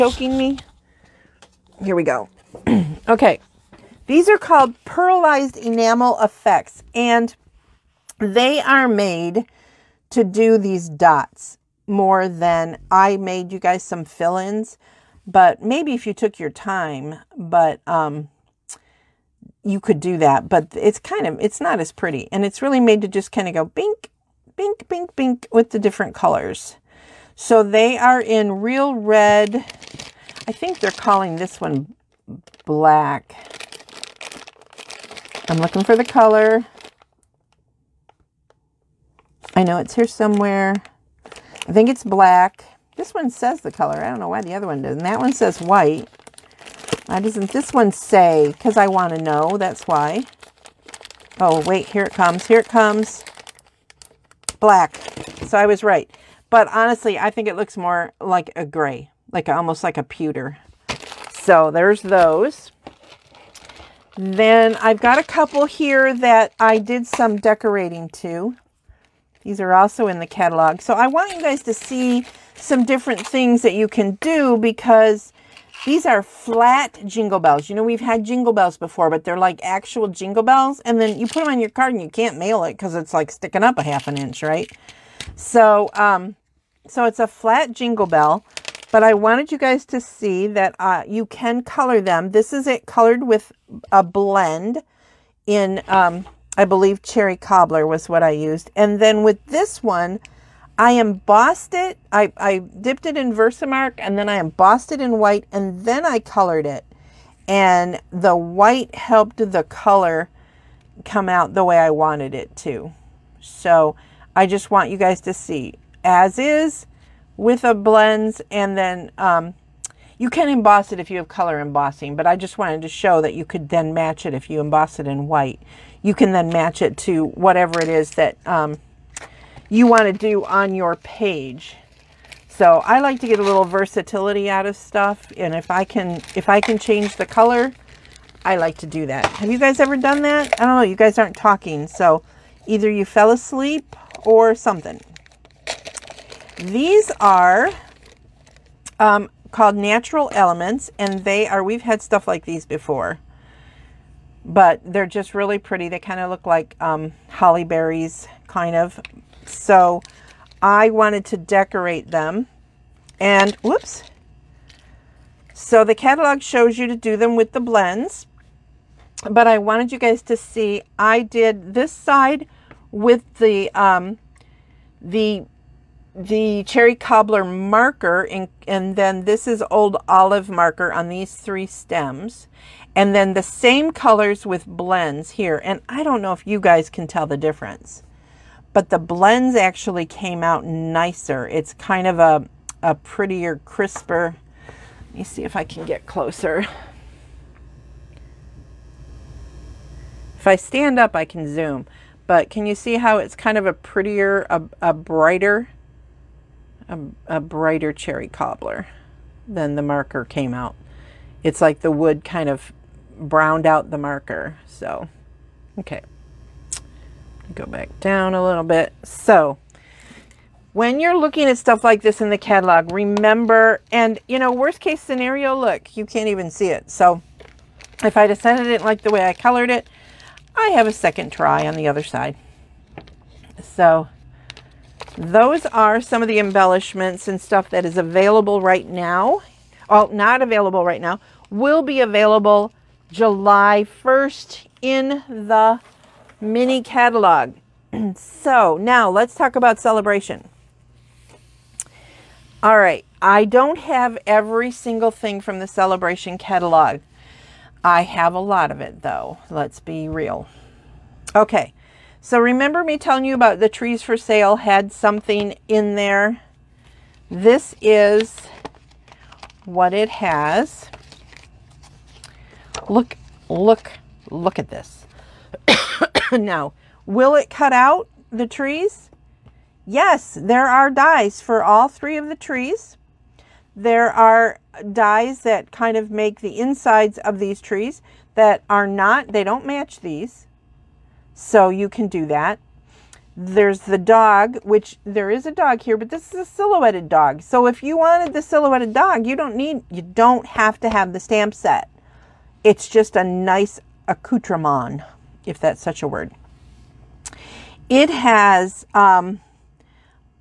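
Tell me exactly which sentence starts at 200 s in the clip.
If I stand up, I can zoom.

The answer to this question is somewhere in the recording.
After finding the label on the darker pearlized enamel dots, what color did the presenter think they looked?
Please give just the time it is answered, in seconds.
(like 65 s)
60 s.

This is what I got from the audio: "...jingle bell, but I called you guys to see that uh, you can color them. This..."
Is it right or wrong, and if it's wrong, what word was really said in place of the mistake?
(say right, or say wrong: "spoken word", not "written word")
wrong: "wanted", not "called".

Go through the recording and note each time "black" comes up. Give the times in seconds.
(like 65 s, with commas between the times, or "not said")
32 s, 42 s, 54 s.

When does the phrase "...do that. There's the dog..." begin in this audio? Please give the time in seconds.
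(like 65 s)
292 s.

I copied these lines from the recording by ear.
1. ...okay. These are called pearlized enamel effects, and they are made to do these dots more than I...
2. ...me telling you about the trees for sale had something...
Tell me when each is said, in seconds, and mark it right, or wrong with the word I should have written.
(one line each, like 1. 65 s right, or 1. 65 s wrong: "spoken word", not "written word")
1. 3 s right
2. 262 s right.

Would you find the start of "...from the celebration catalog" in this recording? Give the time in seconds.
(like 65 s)
255 s.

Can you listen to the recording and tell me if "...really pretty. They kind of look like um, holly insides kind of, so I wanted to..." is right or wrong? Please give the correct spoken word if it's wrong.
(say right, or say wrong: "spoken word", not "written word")
wrong: "berries", not "insides".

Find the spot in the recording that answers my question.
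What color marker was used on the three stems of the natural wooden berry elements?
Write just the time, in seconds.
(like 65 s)
179 s.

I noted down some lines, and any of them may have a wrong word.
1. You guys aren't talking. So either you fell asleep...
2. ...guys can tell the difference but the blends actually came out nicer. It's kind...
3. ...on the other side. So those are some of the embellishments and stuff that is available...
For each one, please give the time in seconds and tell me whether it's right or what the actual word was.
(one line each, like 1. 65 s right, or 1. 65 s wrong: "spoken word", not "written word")
1. 140 s right
2. 186 s right
3. 231 s right.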